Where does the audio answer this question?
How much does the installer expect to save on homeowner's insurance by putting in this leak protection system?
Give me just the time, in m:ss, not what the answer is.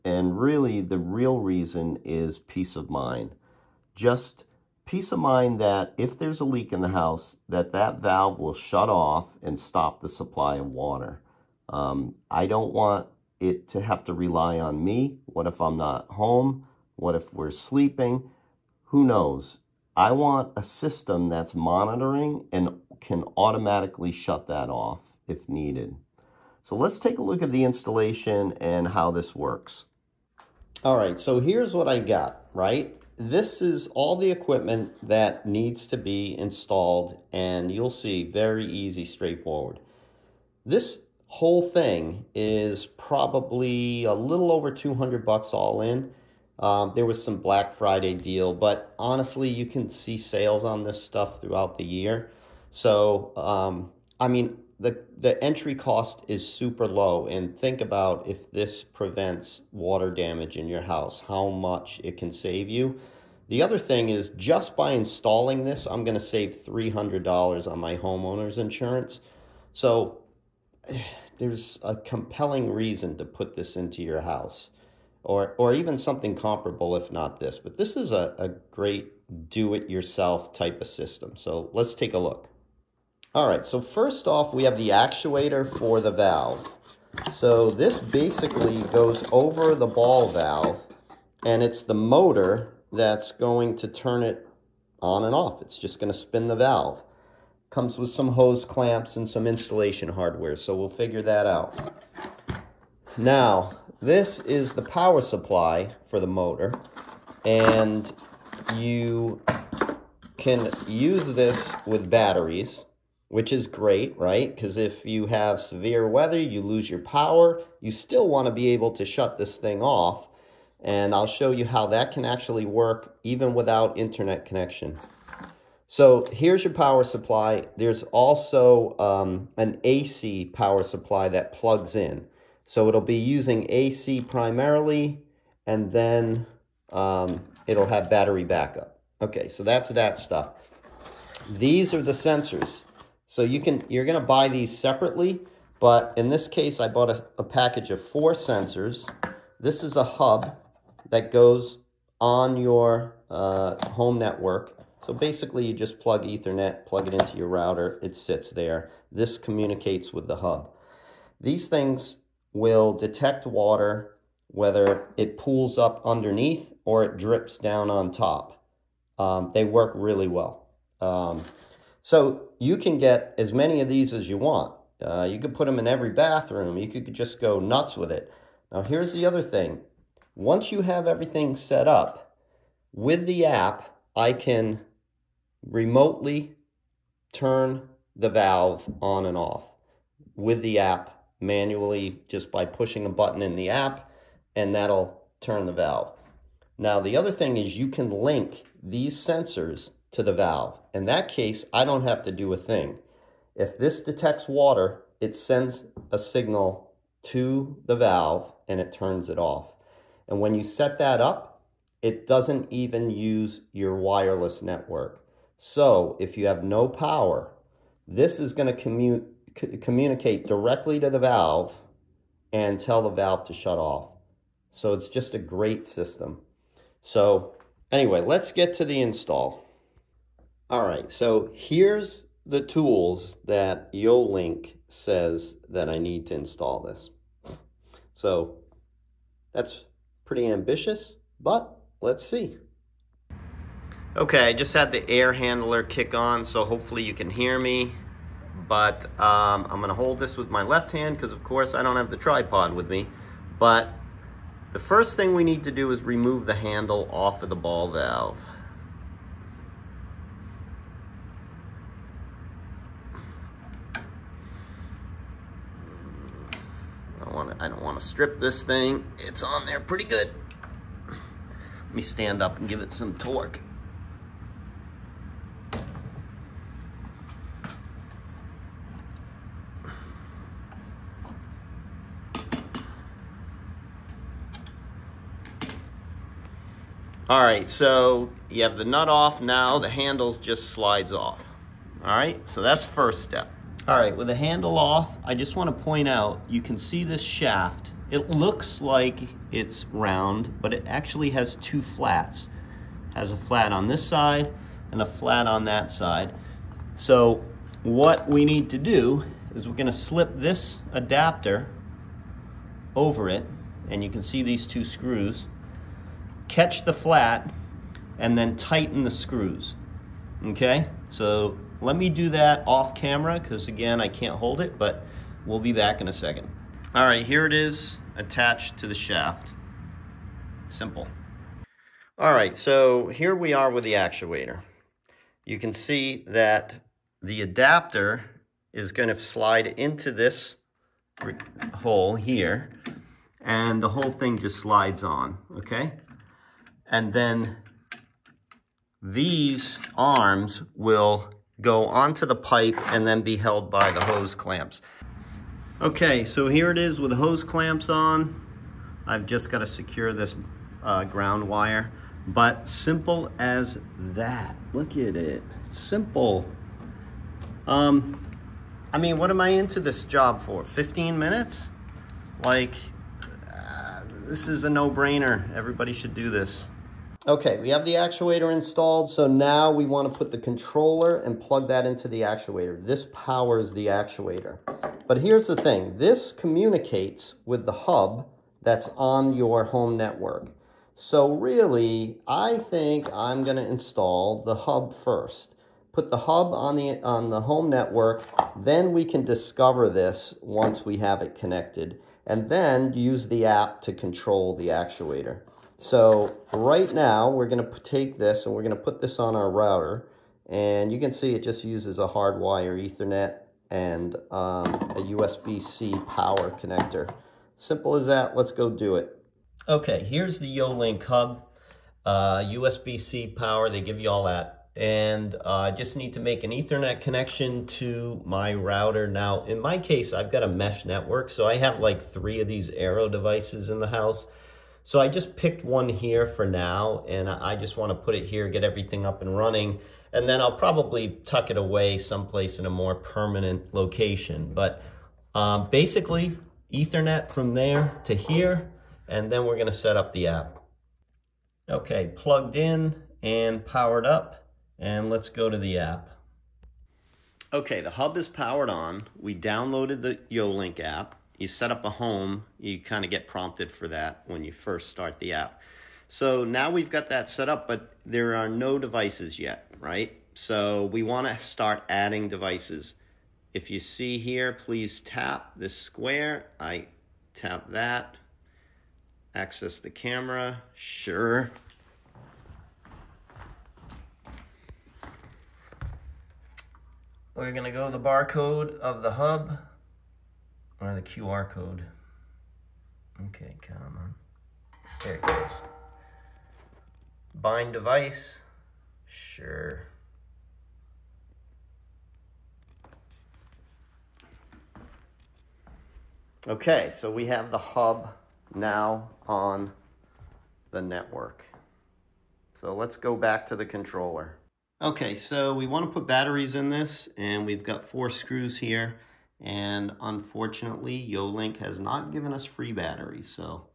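1:06.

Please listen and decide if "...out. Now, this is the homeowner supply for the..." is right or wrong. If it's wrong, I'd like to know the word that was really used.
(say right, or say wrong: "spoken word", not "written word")
wrong: "power", not "homeowner".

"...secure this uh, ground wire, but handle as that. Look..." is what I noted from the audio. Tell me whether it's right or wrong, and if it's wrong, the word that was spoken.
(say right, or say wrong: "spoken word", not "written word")
wrong: "simple", not "handle".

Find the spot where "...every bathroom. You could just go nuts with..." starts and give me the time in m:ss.
2:55.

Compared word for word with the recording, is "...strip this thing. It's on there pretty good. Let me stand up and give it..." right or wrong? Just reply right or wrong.
right.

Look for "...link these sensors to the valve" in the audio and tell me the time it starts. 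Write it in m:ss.
3:18.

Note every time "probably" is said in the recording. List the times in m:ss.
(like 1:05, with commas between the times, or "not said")
0:42, 7:20.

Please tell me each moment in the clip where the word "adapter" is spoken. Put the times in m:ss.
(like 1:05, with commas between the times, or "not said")
5:10, 5:37.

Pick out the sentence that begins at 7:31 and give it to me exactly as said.
Okay, plugged in and powered up, and let's go to the app.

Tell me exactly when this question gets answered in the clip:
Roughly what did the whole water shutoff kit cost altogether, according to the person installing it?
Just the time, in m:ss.
0:44.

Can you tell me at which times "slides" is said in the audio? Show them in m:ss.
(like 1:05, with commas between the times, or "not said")
4:50, 5:39, 5:44.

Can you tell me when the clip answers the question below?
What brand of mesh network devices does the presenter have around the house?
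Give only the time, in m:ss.
7:12.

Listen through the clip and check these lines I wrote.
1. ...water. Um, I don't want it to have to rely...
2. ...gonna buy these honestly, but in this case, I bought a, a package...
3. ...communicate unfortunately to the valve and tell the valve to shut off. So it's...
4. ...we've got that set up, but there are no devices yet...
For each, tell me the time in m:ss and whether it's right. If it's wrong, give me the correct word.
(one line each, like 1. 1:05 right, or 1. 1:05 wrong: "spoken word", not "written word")
1. 0:10 right
2. 2:24 wrong: "separately", not "honestly"
3. 3:39 wrong: "directly", not "unfortunately"
4. 7:46 right.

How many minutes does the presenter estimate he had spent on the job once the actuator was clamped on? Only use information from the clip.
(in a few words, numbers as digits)
15.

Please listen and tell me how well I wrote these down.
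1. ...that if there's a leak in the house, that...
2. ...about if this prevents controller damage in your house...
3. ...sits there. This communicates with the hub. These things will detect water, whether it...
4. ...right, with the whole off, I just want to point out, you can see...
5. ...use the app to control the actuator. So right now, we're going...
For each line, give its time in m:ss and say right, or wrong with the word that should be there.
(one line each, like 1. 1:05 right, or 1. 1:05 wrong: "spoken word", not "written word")
1. 0:05 right
2. 0:57 wrong: "water", not "controller"
3. 2:38 right
4. 4:53 wrong: "handle", not "whole"
5. 6:42 right.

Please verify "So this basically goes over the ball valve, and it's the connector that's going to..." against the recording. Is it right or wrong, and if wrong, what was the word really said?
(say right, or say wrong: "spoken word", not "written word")
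wrong: "motor", not "connector".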